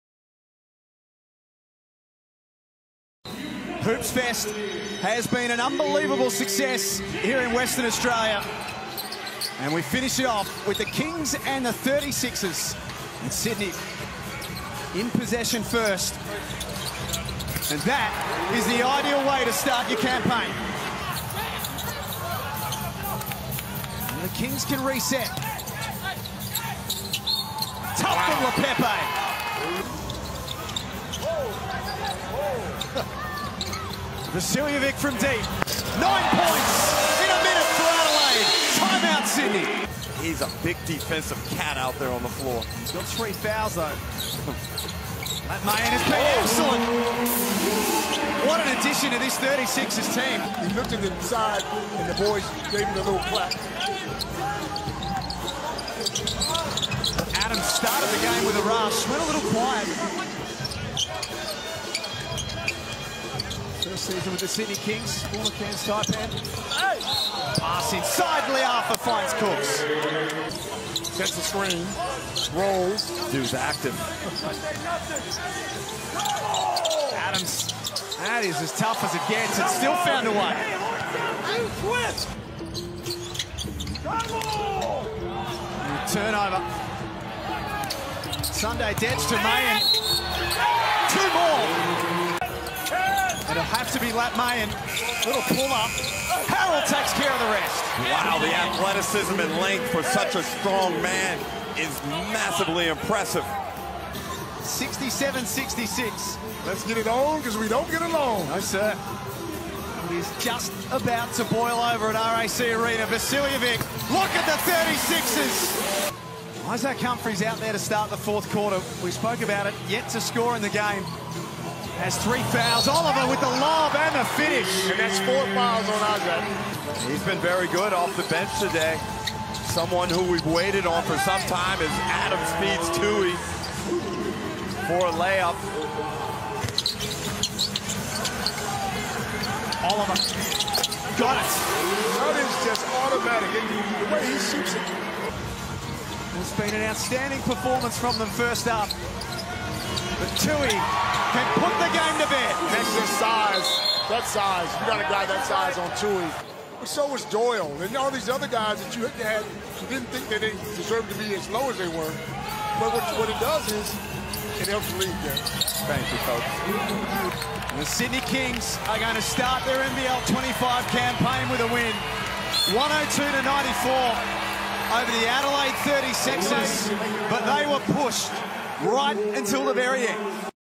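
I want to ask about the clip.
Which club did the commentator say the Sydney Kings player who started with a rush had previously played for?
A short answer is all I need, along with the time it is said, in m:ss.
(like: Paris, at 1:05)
Cairns Taipan, at 1:05.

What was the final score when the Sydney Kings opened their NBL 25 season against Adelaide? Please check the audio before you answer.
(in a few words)
102 to 94.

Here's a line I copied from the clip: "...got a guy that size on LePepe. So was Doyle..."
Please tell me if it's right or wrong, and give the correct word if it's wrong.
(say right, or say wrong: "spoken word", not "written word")
wrong: "Toohey", not "LePepe".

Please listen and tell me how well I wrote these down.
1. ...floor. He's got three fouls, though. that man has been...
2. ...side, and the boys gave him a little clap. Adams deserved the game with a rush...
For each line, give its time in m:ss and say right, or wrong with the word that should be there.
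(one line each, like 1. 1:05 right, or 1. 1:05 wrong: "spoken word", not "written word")
1. 0:42 right
2. 0:51 wrong: "started", not "deserved".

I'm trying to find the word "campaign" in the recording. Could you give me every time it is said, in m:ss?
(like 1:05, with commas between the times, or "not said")
0:19, 2:50.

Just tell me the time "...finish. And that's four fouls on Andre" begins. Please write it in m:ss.
2:04.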